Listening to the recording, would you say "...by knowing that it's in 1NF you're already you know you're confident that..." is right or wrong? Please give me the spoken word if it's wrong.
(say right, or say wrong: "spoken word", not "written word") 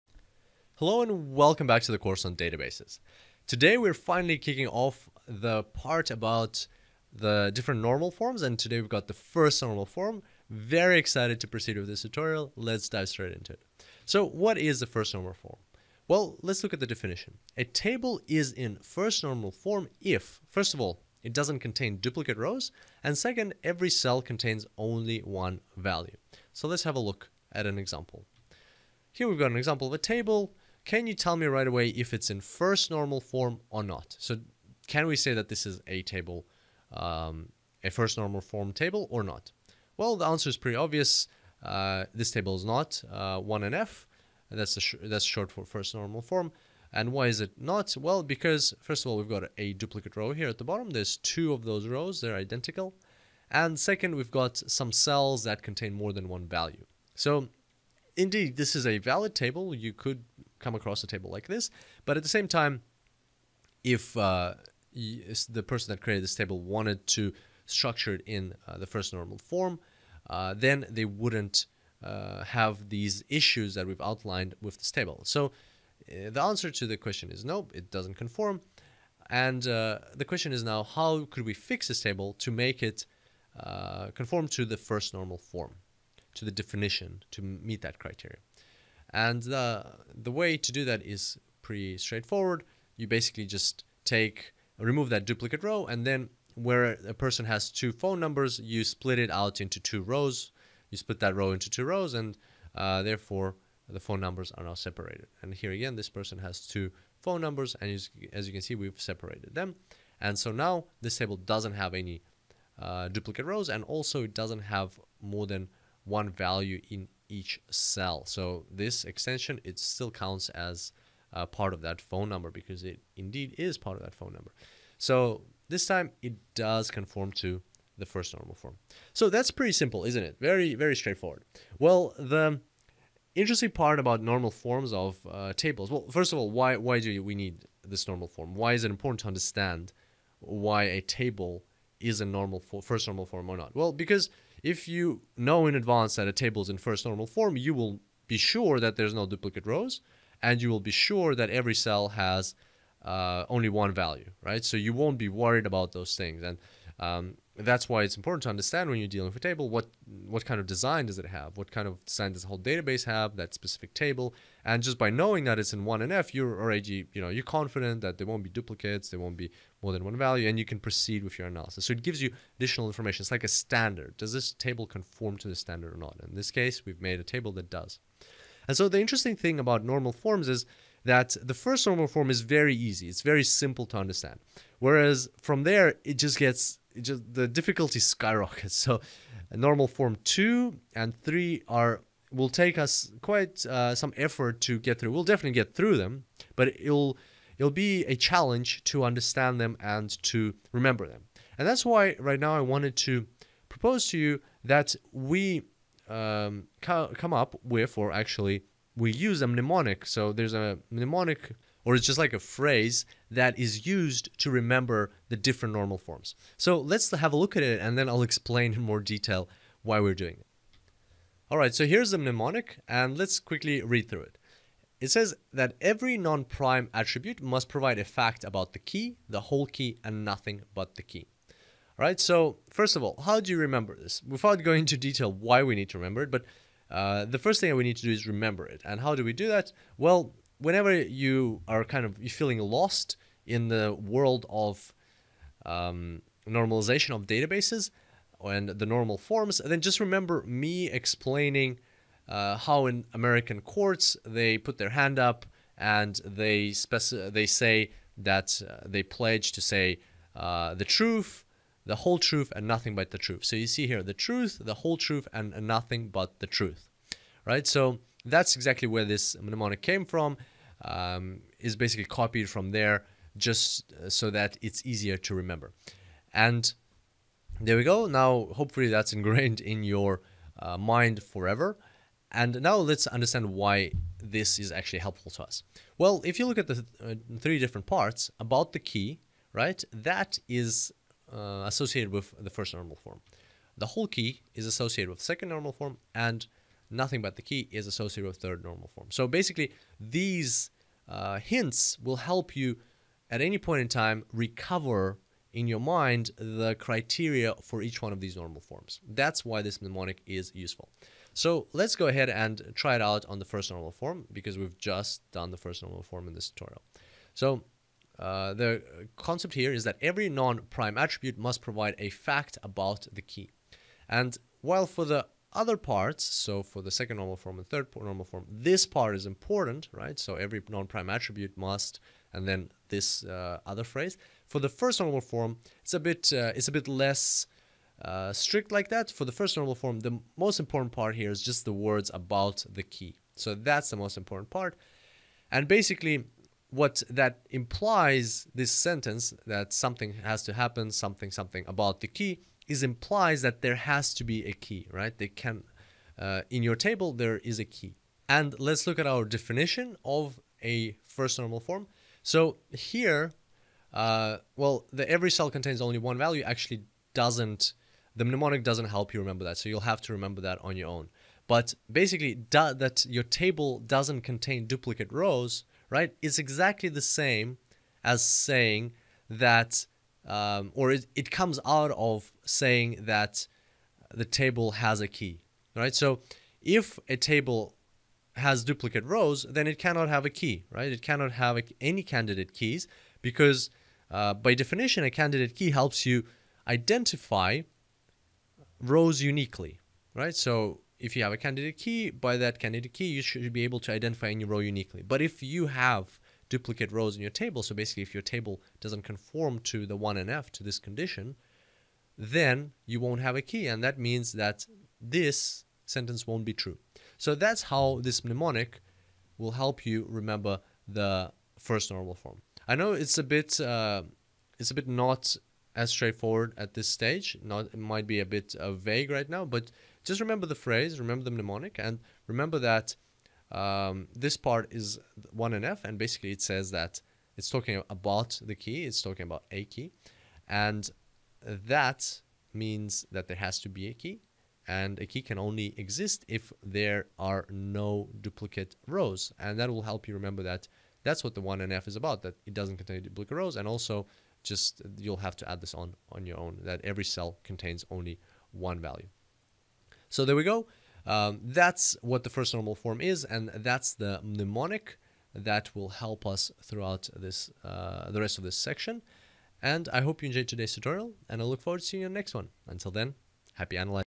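right.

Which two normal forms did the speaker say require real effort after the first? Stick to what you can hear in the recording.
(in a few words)
Two and three.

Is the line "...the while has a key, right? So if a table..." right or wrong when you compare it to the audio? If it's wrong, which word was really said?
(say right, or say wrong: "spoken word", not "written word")
wrong: "table", not "while".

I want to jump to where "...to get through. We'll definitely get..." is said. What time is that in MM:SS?
03:14.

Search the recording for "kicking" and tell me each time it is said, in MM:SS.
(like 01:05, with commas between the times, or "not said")
00:04.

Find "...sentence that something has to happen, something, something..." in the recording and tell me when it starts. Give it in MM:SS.
05:48.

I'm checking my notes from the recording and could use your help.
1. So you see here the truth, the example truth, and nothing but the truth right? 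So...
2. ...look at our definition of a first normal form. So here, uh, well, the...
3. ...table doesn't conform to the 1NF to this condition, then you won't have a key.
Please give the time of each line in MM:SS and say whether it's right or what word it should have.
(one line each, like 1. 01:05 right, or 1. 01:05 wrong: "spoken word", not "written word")
1. 04:23 wrong: "whole", not "example"
2. 05:58 right
3. 06:48 right.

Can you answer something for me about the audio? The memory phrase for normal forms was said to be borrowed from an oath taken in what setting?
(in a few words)
American courts.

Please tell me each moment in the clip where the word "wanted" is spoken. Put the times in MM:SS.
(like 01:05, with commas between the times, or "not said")
01:06, 03:22.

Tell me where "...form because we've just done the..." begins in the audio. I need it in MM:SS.
05:13.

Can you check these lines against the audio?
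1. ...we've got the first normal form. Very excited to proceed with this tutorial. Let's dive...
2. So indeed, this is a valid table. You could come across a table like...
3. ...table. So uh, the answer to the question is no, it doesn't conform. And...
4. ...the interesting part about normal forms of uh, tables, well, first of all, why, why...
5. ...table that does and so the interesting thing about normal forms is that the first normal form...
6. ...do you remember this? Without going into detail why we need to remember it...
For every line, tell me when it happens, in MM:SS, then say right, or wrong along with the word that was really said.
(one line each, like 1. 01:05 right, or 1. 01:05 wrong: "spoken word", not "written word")
1. 00:08 right
2. 00:57 right
3. 01:14 right
4. 02:12 right
5. 02:57 right
6. 03:53 right.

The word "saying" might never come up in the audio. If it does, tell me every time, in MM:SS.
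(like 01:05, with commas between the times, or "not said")
06:18, 06:22.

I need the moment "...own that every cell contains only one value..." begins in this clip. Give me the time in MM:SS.
07:36.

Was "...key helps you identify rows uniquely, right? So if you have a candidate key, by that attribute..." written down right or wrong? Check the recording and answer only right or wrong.
wrong.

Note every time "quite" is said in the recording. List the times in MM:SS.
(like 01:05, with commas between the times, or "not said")
03:13.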